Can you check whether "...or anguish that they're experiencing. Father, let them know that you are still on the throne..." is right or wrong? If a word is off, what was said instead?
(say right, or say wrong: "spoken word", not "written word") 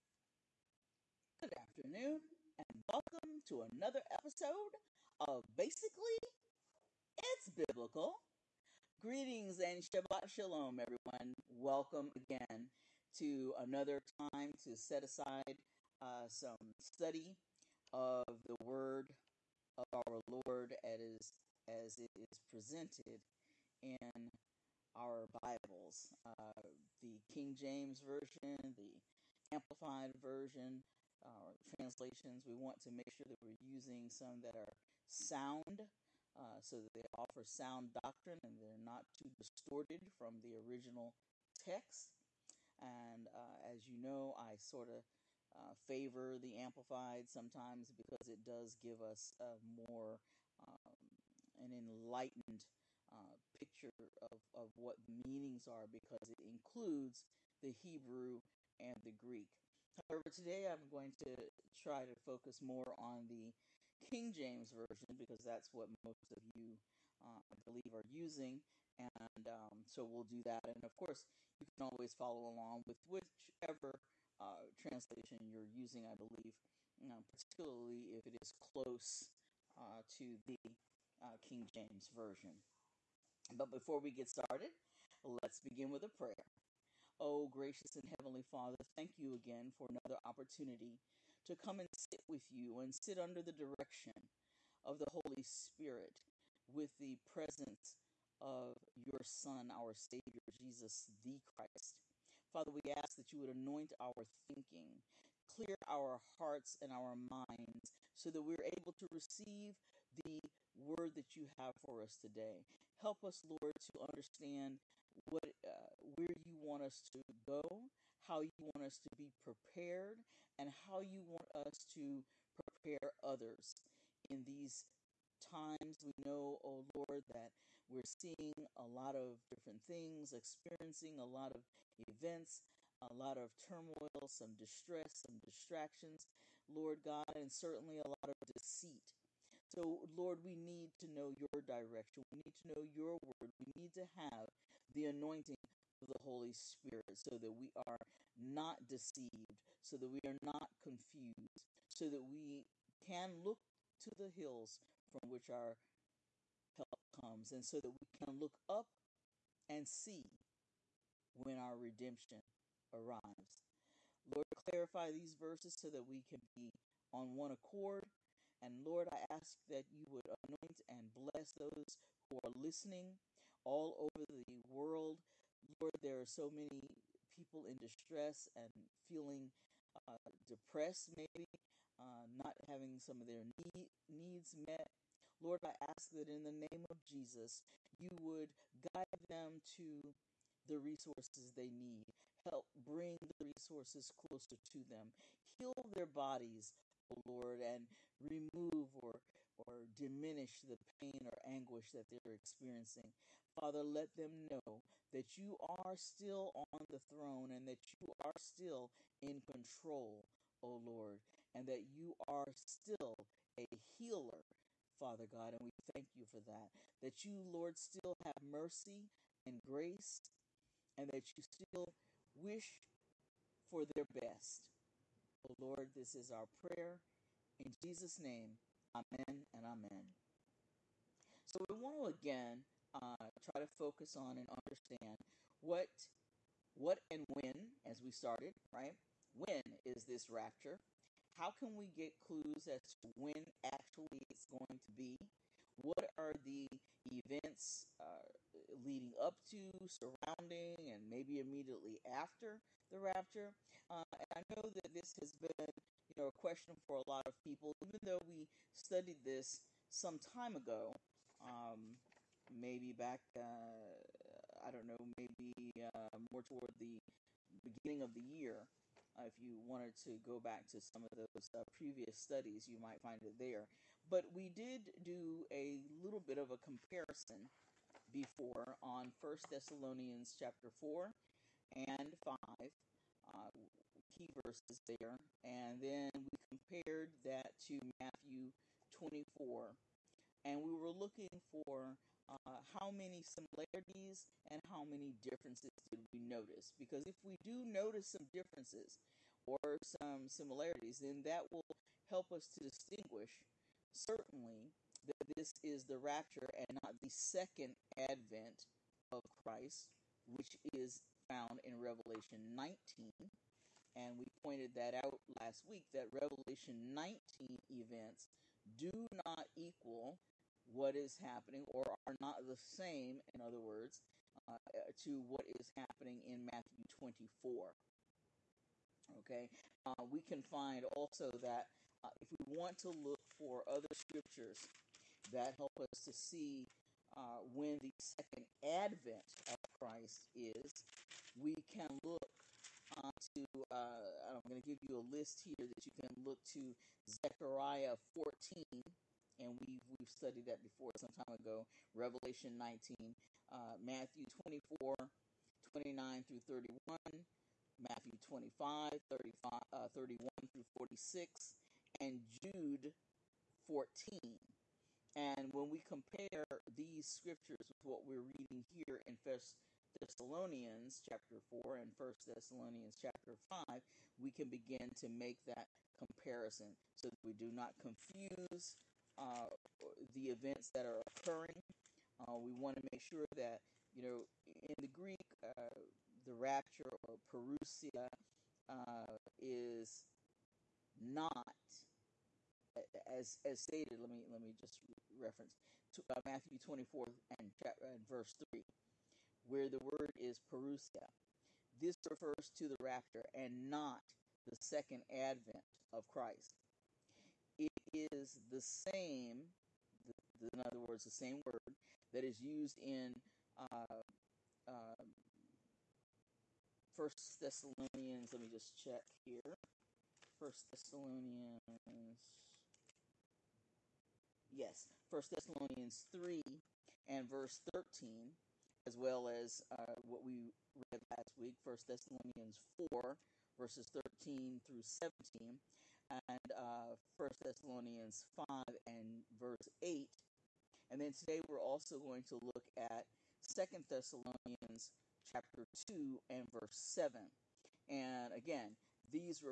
right.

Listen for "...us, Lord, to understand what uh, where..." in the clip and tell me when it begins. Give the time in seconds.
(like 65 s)
113 s.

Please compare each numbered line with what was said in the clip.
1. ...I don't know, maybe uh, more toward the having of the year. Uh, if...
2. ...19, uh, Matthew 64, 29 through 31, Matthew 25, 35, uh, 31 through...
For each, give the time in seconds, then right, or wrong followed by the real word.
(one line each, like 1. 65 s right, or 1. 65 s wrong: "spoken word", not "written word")
1. 264 s wrong: "beginning", not "having"
2. 352 s wrong: "24", not "64".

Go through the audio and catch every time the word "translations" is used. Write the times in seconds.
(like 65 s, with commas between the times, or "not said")
31 s, 74 s.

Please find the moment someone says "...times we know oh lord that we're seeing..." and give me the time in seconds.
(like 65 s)
125 s.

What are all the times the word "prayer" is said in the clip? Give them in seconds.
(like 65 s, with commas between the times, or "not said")
86 s, 226 s.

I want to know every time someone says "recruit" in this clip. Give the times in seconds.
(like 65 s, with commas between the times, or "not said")
not said.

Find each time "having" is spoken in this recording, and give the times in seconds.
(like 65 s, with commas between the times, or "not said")
182 s.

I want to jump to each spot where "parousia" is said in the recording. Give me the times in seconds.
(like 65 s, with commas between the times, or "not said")
387 s, 400 s.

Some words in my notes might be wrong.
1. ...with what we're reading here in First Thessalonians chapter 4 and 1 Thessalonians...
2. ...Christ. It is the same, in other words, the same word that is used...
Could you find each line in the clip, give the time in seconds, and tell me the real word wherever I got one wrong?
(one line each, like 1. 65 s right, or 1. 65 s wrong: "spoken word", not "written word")
1. 367 s right
2. 406 s right.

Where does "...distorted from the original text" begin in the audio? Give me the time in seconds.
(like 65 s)
39 s.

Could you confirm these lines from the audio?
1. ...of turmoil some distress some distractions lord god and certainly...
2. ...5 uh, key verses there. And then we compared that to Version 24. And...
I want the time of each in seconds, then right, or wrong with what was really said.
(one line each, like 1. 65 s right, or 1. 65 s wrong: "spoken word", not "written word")
1. 133 s right
2. 282 s wrong: "Matthew", not "Version".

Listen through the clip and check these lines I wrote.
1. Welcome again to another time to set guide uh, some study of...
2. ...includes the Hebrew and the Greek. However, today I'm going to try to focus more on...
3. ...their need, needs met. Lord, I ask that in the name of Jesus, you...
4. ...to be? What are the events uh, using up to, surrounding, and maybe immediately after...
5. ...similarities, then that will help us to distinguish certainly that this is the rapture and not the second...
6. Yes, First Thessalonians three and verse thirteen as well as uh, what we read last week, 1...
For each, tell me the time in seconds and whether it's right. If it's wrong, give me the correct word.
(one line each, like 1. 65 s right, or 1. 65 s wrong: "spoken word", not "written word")
1. 11 s wrong: "aside", not "guide"
2. 56 s right
3. 183 s right
4. 244 s wrong: "leading", not "using"
5. 300 s right
6. 424 s right.